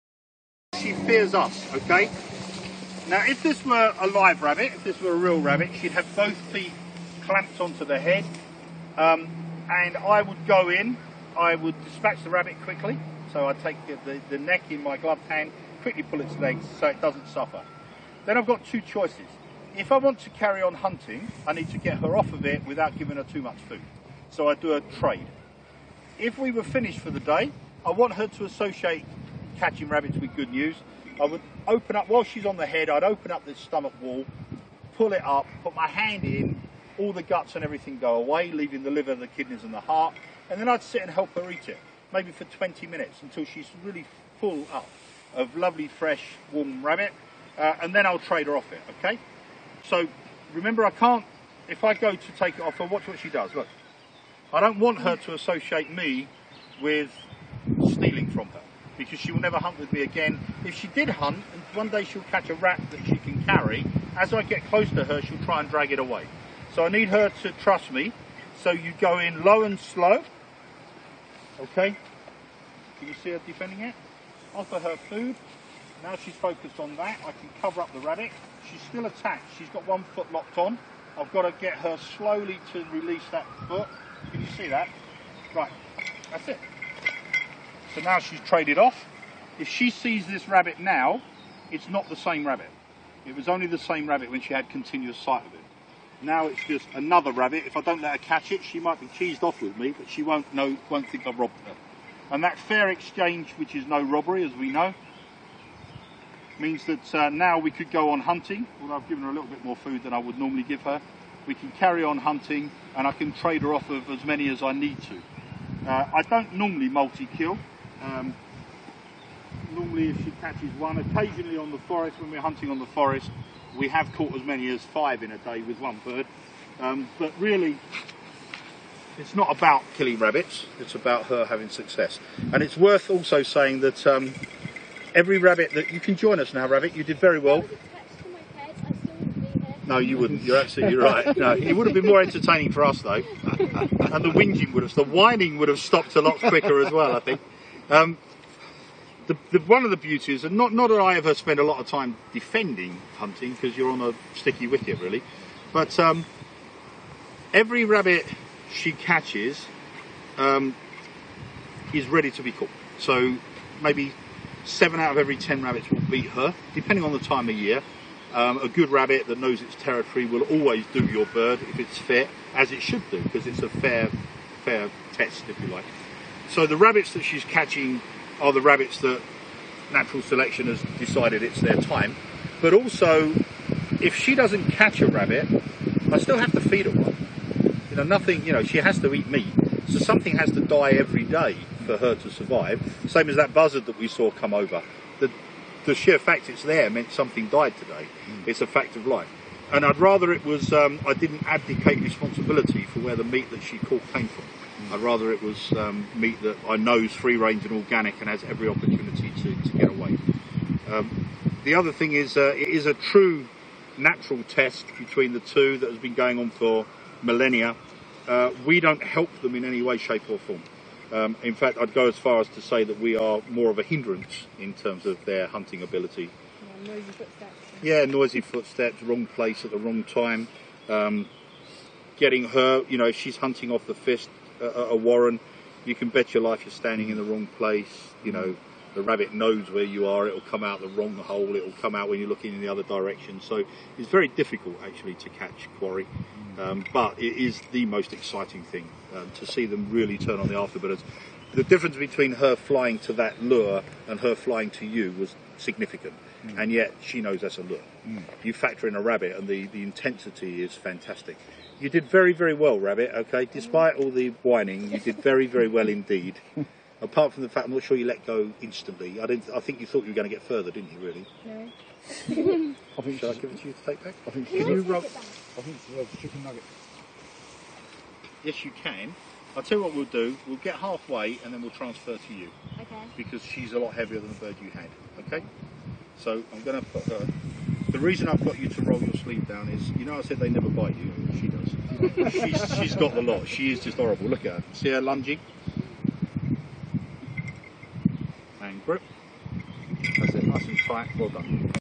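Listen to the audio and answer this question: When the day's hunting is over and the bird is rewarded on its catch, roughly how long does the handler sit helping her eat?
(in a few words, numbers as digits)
20 minutes.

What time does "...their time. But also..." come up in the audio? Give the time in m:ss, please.
3:01.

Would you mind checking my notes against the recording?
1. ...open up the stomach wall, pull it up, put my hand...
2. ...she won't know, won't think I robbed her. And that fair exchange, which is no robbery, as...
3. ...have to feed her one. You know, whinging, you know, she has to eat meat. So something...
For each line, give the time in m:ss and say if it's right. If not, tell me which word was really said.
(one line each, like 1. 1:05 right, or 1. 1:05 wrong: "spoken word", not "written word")
1. 0:33 right
2. 1:40 right
3. 3:06 wrong: "nothing", not "whinging".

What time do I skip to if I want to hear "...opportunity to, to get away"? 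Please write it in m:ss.
3:28.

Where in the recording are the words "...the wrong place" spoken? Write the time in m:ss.
3:57.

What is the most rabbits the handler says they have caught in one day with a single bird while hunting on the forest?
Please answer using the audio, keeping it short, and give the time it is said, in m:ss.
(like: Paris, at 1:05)
5, at 2:04.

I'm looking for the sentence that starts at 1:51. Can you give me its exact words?
We can carry on hunting and I can trade her off of as many as I need to.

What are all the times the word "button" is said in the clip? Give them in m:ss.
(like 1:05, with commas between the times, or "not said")
not said.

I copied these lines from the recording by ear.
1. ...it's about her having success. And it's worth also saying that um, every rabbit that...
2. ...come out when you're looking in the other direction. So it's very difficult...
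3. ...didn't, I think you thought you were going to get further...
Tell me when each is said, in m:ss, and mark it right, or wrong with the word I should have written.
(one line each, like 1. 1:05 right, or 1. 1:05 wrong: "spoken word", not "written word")
1. 2:10 right
2. 4:01 right
3. 4:29 right.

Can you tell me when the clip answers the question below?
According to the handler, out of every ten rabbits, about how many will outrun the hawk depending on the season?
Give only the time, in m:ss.
2:44.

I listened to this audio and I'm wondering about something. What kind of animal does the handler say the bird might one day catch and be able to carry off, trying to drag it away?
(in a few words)
rat.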